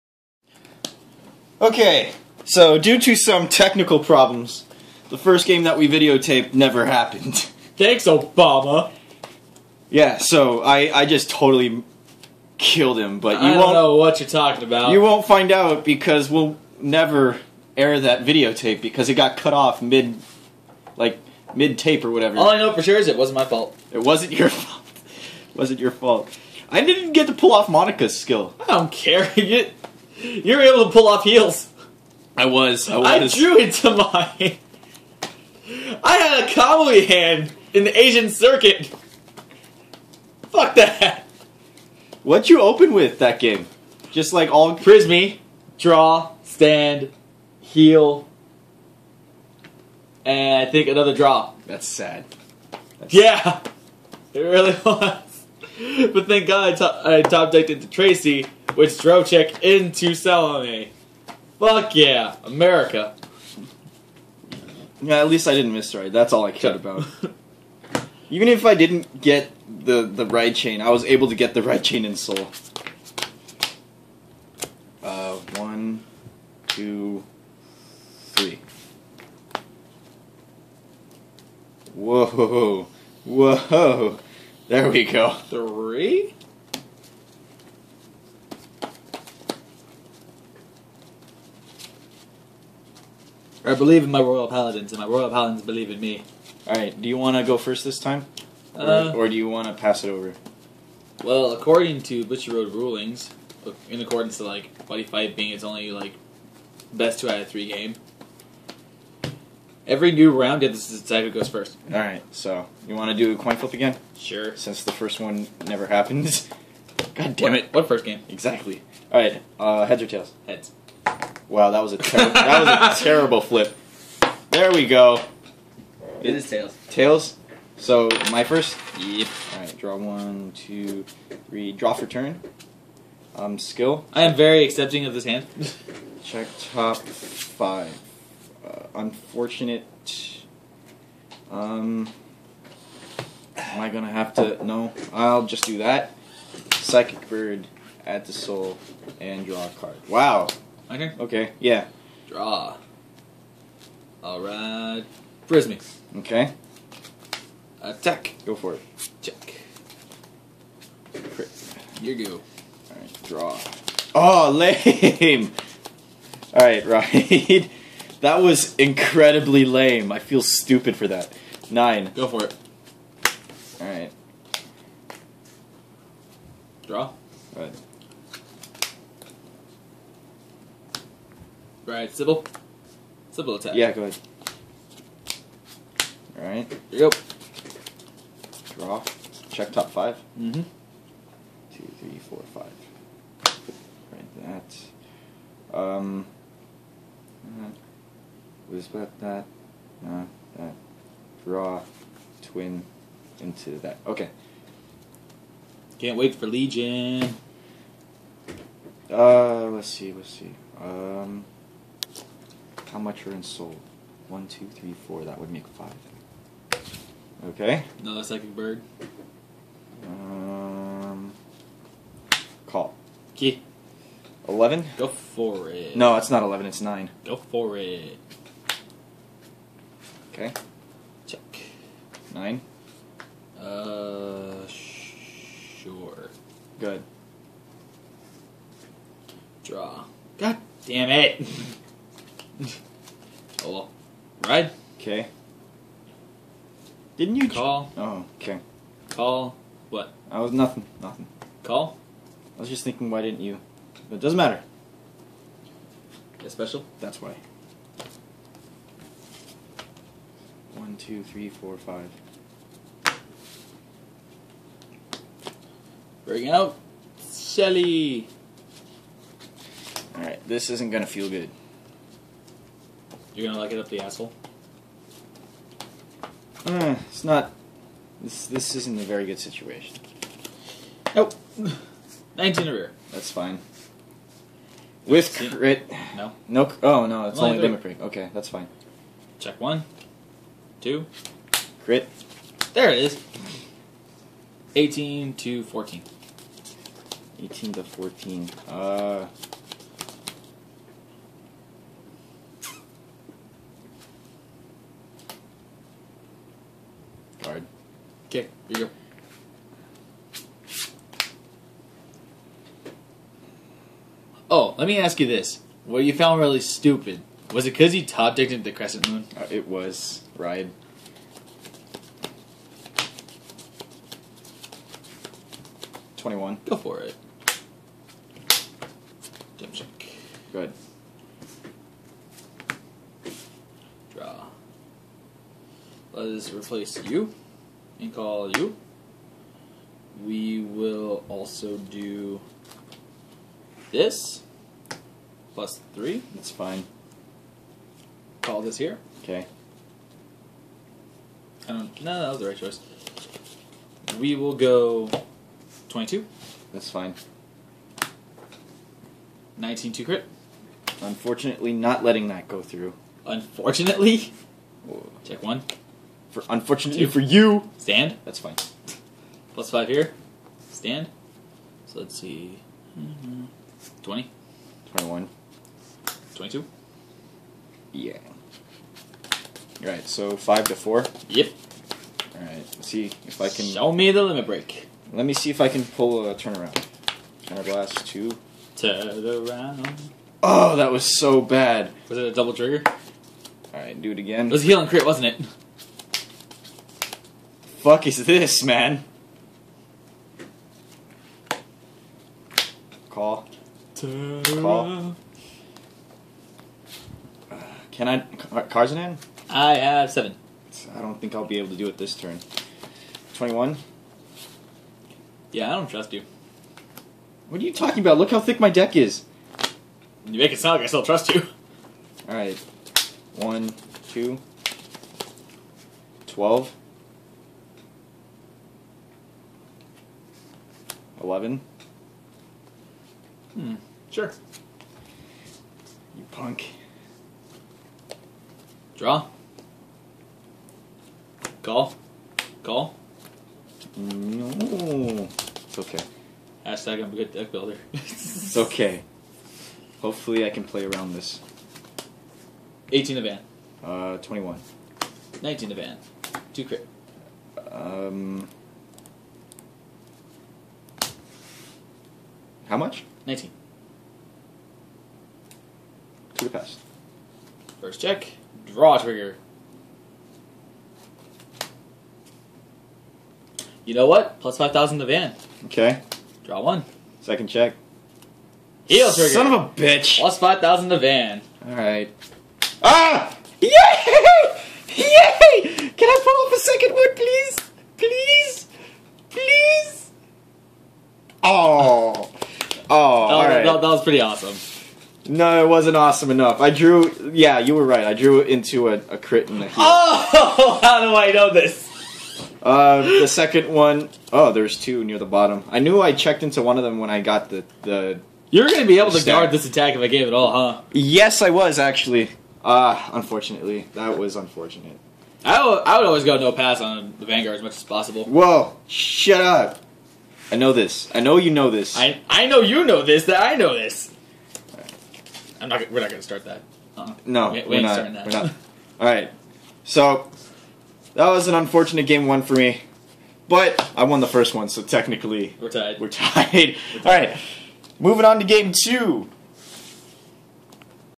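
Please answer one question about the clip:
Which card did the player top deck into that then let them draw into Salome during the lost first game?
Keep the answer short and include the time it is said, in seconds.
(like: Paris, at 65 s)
Tracie, at 57 s.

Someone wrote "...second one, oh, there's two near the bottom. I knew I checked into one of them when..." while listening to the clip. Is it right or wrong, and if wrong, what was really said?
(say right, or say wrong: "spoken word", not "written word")
right.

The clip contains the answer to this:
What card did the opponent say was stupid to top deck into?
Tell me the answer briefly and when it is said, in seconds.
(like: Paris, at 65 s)
crescent moon, at 318 s.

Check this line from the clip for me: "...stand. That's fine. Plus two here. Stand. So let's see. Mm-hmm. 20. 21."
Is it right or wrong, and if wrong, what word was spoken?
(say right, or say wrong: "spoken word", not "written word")
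wrong: "five", not "two".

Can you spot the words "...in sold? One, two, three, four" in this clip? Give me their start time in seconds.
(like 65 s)
213 s.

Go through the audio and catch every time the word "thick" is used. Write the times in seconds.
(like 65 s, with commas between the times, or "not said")
418 s.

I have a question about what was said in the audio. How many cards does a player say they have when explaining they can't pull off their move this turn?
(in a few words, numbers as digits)
7.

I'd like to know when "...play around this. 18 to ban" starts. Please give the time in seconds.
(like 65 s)
450 s.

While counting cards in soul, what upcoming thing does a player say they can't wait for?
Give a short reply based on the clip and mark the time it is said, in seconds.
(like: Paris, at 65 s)
Legion, at 206 s.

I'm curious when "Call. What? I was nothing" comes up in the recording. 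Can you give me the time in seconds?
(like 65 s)
249 s.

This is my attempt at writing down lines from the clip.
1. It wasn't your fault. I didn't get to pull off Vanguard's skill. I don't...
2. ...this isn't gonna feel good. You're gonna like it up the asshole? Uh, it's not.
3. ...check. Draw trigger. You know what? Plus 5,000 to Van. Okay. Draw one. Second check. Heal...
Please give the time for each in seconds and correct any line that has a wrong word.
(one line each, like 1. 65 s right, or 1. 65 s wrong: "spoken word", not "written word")
1. 25 s wrong: "Monaka", not "Vanguard"
2. 270 s right
3. 467 s right.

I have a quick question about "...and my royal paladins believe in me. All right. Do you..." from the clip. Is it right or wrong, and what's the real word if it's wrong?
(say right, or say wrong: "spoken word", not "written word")
right.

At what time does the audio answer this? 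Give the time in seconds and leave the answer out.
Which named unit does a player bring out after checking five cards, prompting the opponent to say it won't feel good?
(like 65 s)
267 s.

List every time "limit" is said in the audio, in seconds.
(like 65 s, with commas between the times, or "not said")
287 s, 384 s.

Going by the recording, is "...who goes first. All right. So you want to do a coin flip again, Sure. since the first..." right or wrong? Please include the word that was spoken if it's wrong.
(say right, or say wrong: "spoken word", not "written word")
right.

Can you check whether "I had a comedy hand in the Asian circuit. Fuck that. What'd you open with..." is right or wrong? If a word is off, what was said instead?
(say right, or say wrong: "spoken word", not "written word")
right.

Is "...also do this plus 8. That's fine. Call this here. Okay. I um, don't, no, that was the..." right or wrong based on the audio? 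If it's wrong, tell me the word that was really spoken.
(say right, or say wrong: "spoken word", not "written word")
wrong: "3", not "8".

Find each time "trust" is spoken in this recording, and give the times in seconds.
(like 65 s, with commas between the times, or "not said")
415 s, 421 s.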